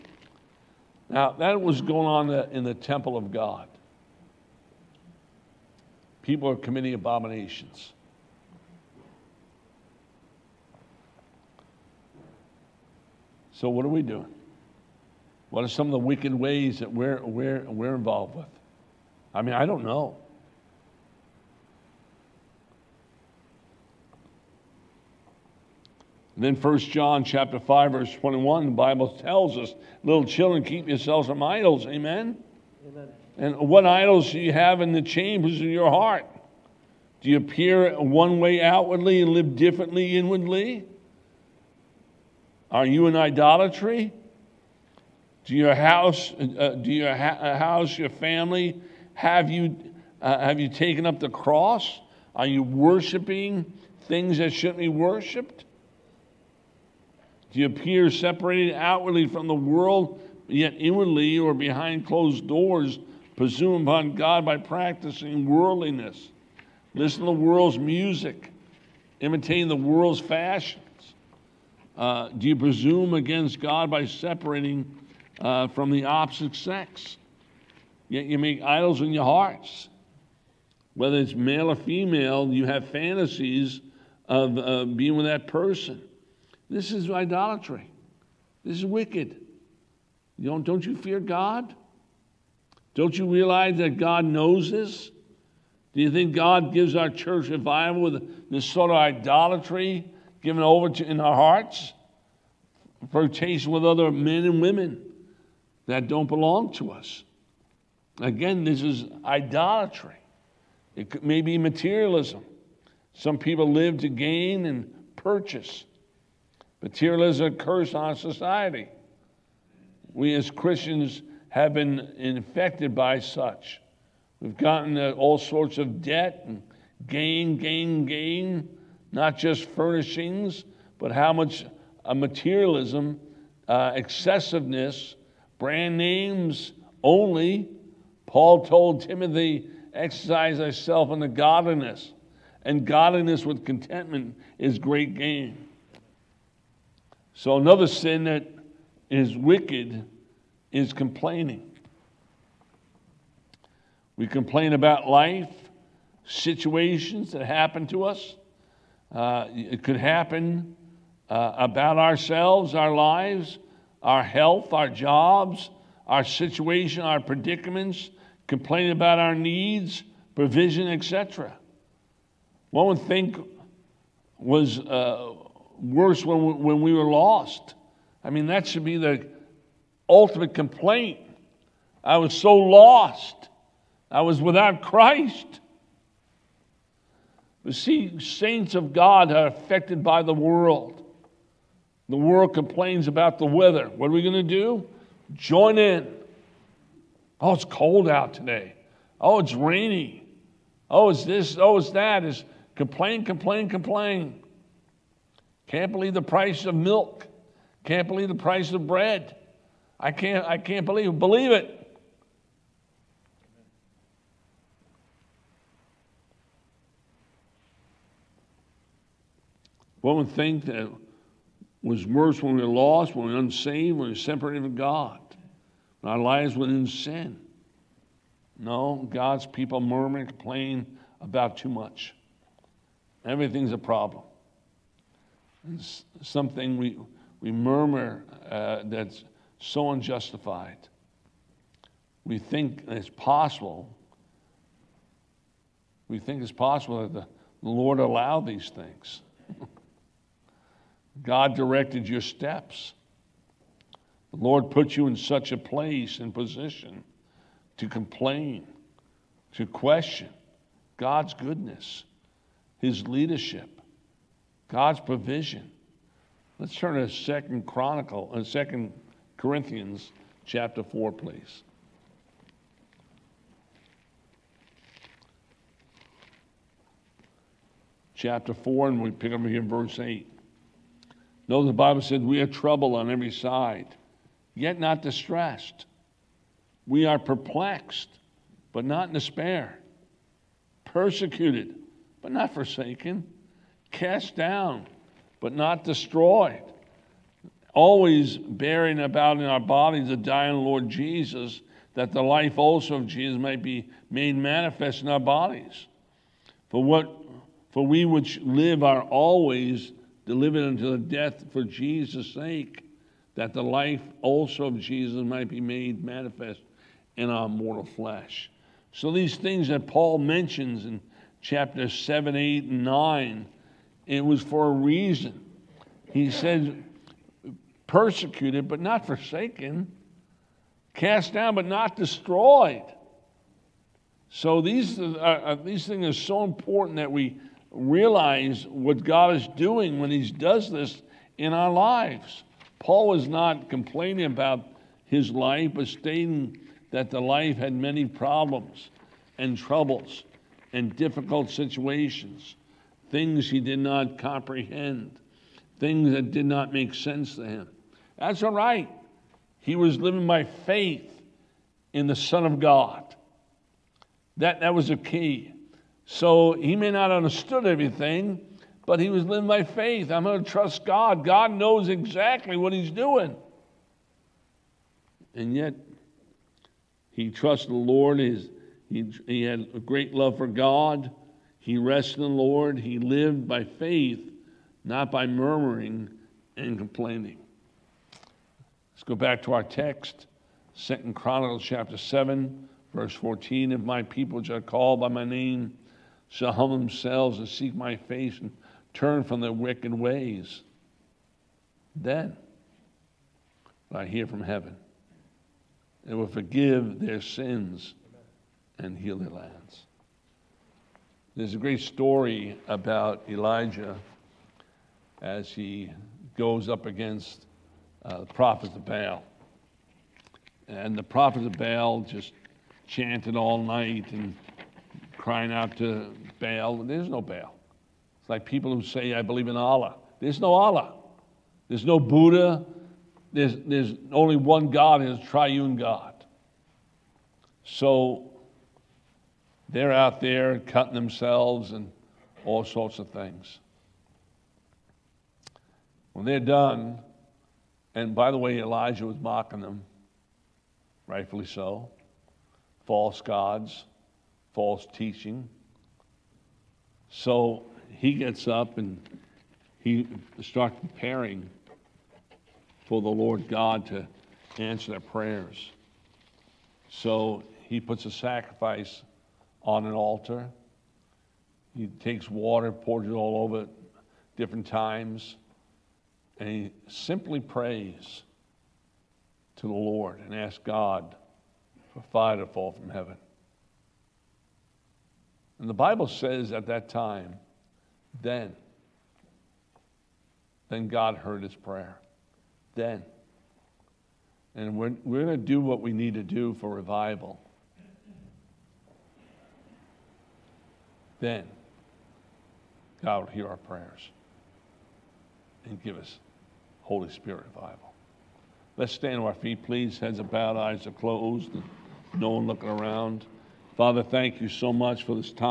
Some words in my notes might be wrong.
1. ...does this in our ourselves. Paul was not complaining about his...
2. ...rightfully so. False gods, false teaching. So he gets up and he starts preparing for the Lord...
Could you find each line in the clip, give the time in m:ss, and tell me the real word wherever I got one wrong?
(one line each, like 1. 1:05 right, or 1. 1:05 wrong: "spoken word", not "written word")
1. 5:40 wrong: "lives", not "ourselves"
2. 7:31 right.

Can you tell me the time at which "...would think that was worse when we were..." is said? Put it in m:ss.
3:40.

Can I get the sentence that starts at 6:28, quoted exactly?
Let's go back to our text, Second Chronicles chapter 7, verse 14.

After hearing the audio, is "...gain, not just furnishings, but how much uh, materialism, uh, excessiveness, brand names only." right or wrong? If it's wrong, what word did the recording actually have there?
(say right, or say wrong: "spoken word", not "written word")
right.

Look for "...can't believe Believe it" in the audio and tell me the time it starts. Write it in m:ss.
3:30.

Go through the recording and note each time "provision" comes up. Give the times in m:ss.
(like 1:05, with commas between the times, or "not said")
2:50, 4:24.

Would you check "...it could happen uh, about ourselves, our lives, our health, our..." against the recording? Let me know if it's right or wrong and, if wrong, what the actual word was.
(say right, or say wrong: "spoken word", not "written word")
right.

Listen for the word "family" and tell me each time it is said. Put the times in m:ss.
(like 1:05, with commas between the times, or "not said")
0:48.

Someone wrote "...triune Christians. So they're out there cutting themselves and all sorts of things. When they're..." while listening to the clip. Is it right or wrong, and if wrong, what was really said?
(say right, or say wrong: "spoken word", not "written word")
wrong: "God", not "Christians".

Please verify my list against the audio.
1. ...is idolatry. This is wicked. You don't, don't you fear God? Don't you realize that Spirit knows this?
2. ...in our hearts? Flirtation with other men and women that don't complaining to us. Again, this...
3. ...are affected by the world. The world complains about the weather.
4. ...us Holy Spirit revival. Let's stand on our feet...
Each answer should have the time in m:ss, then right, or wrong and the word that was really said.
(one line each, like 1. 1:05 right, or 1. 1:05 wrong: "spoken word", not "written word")
1. 1:26 wrong: "God", not "Spirit"
2. 1:41 wrong: "belong", not "complaining"
3. 3:09 right
4. 8:25 right.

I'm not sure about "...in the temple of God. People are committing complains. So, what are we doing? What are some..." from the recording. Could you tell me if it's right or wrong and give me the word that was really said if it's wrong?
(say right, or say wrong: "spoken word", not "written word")
wrong: "abominations", not "complains".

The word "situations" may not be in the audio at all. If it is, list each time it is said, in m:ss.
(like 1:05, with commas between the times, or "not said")
2:36, 2:46, 5:51.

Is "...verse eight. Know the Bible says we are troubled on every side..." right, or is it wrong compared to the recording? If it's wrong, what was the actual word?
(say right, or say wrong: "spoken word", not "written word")
right.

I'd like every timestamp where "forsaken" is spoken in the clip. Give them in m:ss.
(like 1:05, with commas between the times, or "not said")
4:52, 5:29.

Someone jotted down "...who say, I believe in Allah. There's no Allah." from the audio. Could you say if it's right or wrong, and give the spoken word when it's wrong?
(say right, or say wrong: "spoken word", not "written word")
right.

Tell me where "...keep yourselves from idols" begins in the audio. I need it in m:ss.
0:30.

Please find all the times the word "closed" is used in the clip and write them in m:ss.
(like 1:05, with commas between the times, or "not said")
1:02, 8:30.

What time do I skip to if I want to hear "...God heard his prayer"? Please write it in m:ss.
8:10.